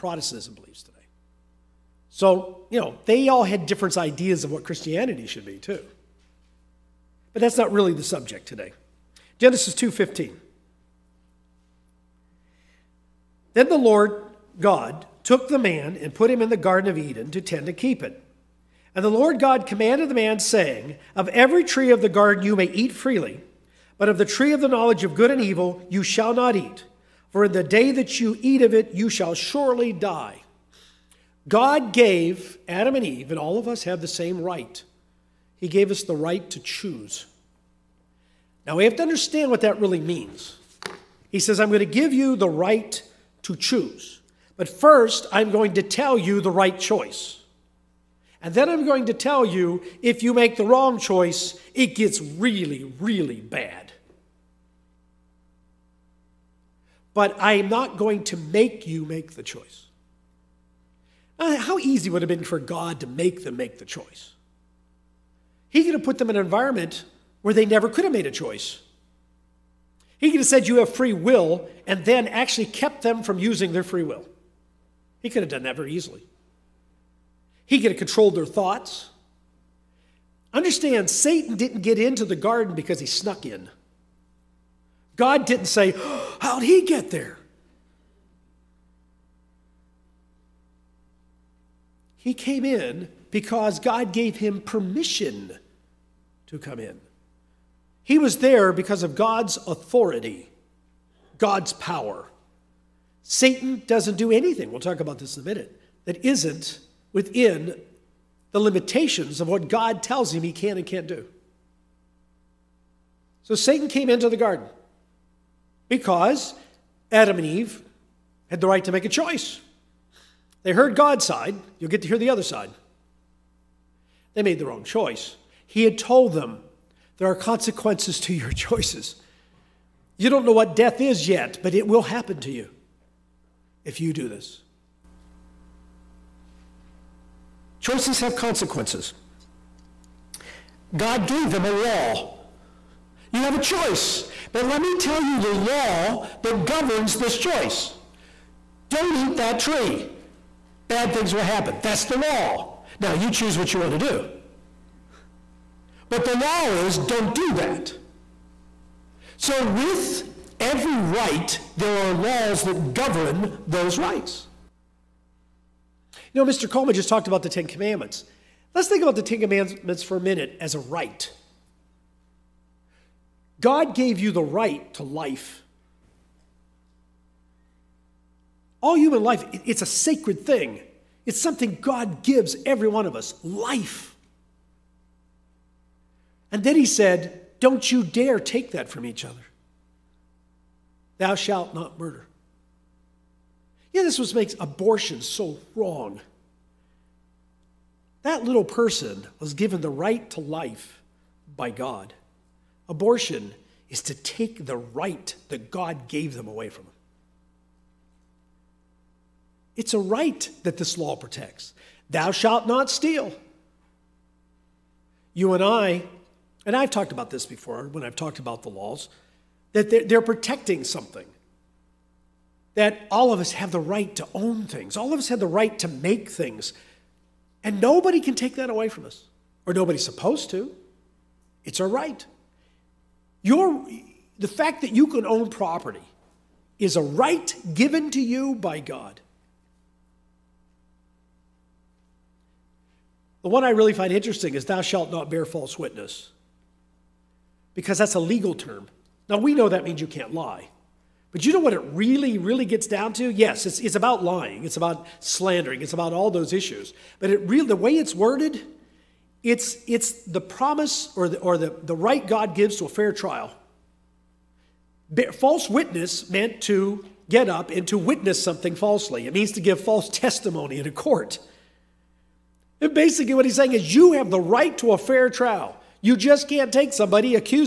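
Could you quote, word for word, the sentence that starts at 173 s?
God gave you the right to life.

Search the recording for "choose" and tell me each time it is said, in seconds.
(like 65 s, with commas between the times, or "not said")
36 s, 43 s, 153 s.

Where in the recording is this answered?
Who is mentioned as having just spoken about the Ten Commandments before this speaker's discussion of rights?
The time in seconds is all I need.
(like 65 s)
166 s.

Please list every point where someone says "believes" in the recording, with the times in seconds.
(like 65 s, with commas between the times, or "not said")
0 s.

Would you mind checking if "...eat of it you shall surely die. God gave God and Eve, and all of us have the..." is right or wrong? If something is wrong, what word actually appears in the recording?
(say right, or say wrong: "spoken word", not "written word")
wrong: "Adam", not "God".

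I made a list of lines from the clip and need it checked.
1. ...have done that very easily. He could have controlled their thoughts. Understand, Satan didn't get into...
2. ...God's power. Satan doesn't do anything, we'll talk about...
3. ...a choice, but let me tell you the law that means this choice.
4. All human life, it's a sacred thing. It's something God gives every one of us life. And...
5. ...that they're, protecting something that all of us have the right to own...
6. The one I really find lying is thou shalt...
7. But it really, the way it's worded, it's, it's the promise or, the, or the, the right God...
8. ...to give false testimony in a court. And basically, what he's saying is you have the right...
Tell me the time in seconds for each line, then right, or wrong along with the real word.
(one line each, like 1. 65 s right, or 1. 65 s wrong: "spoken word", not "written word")
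1. 75 s right
2. 101 s right
3. 143 s wrong: "governs", not "means"
4. 178 s right
5. 219 s right
6. 243 s wrong: "interesting", not "lying"
7. 257 s right
8. 269 s right.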